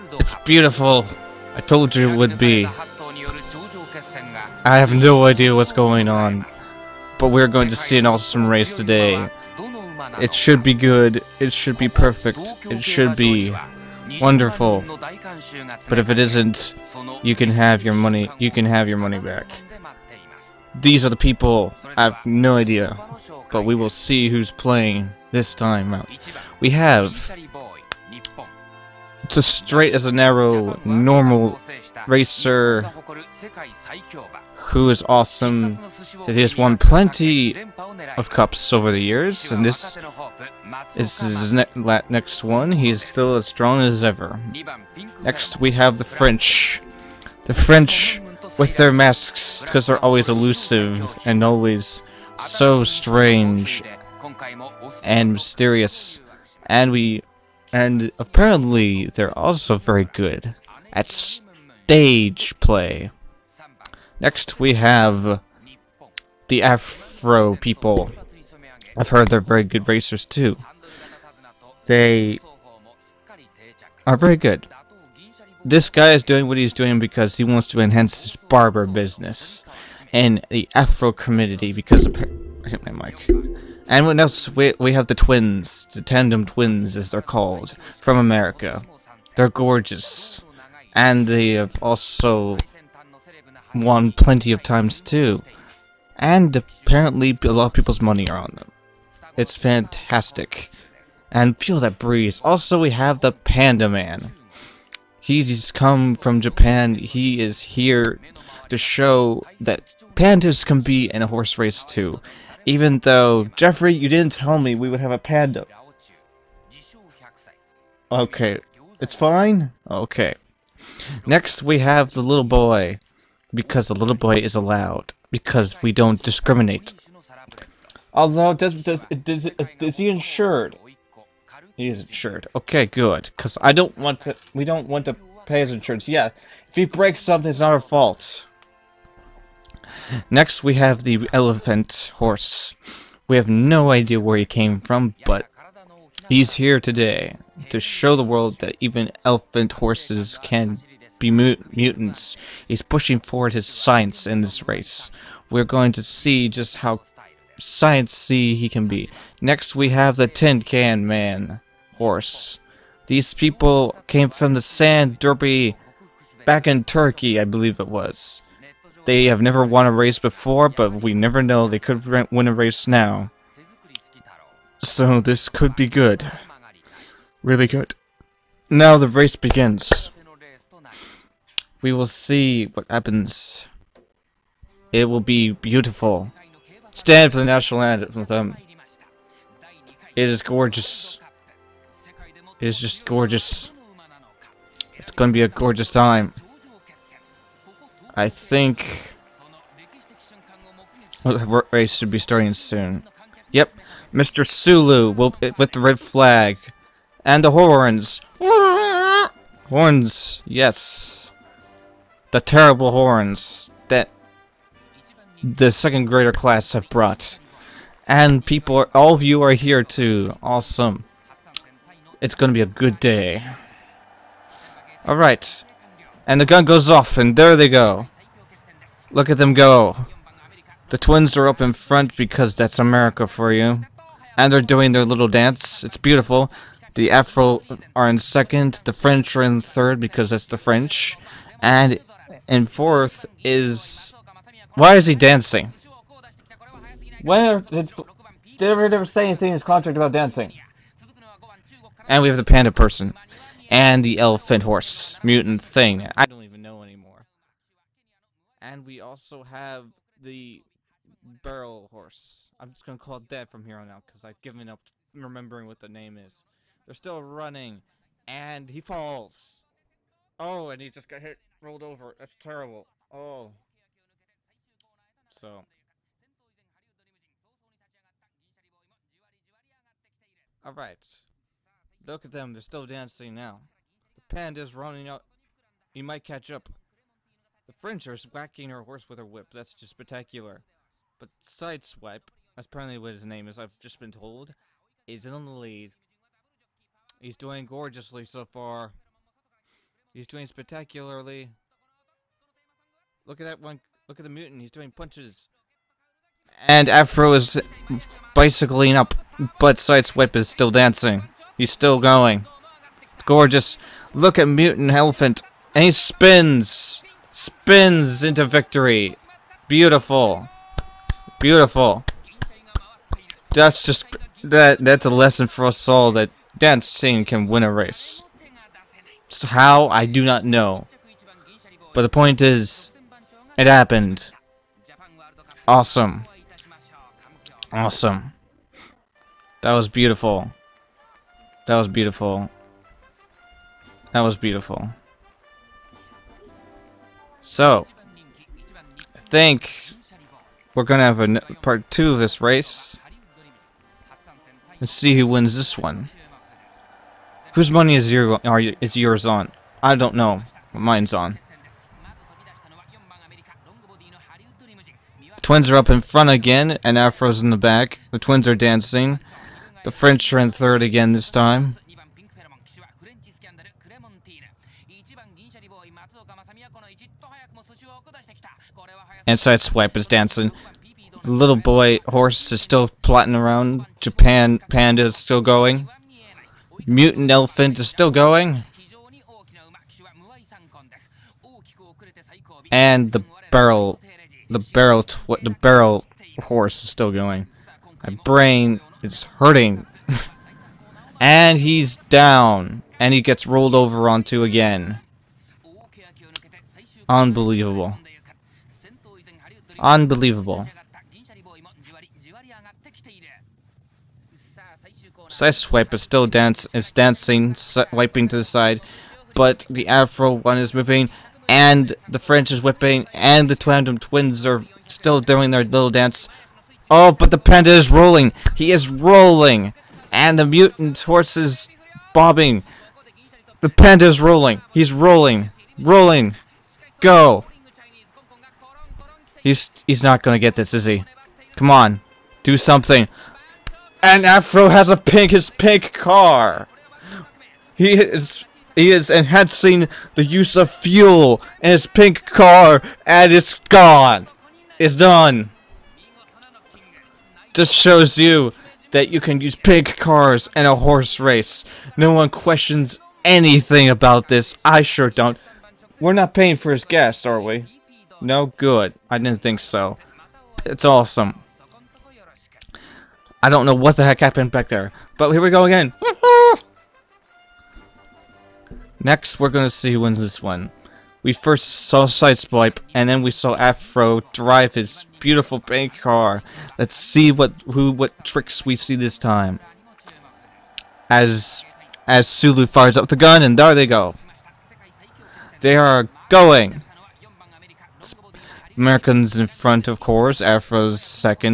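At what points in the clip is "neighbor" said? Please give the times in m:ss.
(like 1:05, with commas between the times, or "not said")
not said.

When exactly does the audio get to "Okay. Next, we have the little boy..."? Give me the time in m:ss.
1:59.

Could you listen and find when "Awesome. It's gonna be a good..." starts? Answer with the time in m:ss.
3:40.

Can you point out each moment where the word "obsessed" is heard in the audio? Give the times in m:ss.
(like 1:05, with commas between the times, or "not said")
not said.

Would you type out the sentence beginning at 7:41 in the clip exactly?
No one questions anything about this.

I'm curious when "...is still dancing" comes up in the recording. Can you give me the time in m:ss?
5:10.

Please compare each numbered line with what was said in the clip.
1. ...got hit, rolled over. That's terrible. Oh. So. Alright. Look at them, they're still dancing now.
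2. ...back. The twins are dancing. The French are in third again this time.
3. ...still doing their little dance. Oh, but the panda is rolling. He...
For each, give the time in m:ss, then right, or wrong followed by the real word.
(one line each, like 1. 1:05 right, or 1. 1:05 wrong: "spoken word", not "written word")
1. 4:31 right
2. 6:07 right
3. 7:04 right.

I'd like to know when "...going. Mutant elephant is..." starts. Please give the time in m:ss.
6:25.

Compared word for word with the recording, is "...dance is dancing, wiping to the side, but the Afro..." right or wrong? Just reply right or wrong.
right.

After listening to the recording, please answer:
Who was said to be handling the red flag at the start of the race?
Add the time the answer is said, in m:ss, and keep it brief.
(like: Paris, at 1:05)
Mr. Sulu, at 3:24.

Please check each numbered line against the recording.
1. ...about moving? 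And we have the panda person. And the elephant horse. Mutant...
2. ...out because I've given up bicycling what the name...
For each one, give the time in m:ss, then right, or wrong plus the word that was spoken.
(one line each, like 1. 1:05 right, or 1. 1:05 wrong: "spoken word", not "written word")
1. 4:09 wrong: "dancing", not "moving"
2. 4:23 wrong: "remembering", not "bicycling".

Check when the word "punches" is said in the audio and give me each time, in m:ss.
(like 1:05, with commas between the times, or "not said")
5:04.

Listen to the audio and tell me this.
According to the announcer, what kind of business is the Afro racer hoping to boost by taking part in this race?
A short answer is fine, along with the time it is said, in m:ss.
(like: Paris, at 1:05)
Barber business, at 1:18.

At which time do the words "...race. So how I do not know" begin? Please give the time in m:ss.
5:27.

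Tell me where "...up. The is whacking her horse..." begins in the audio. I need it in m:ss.
4:46.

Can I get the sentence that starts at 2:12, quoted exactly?
Okay, good, because I don't want to, we don't want to pay his insurance.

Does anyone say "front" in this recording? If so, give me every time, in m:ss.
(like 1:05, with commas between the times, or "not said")
3:51, 6:05, 8:19.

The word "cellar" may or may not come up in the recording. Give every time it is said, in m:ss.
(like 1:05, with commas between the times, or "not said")
not said.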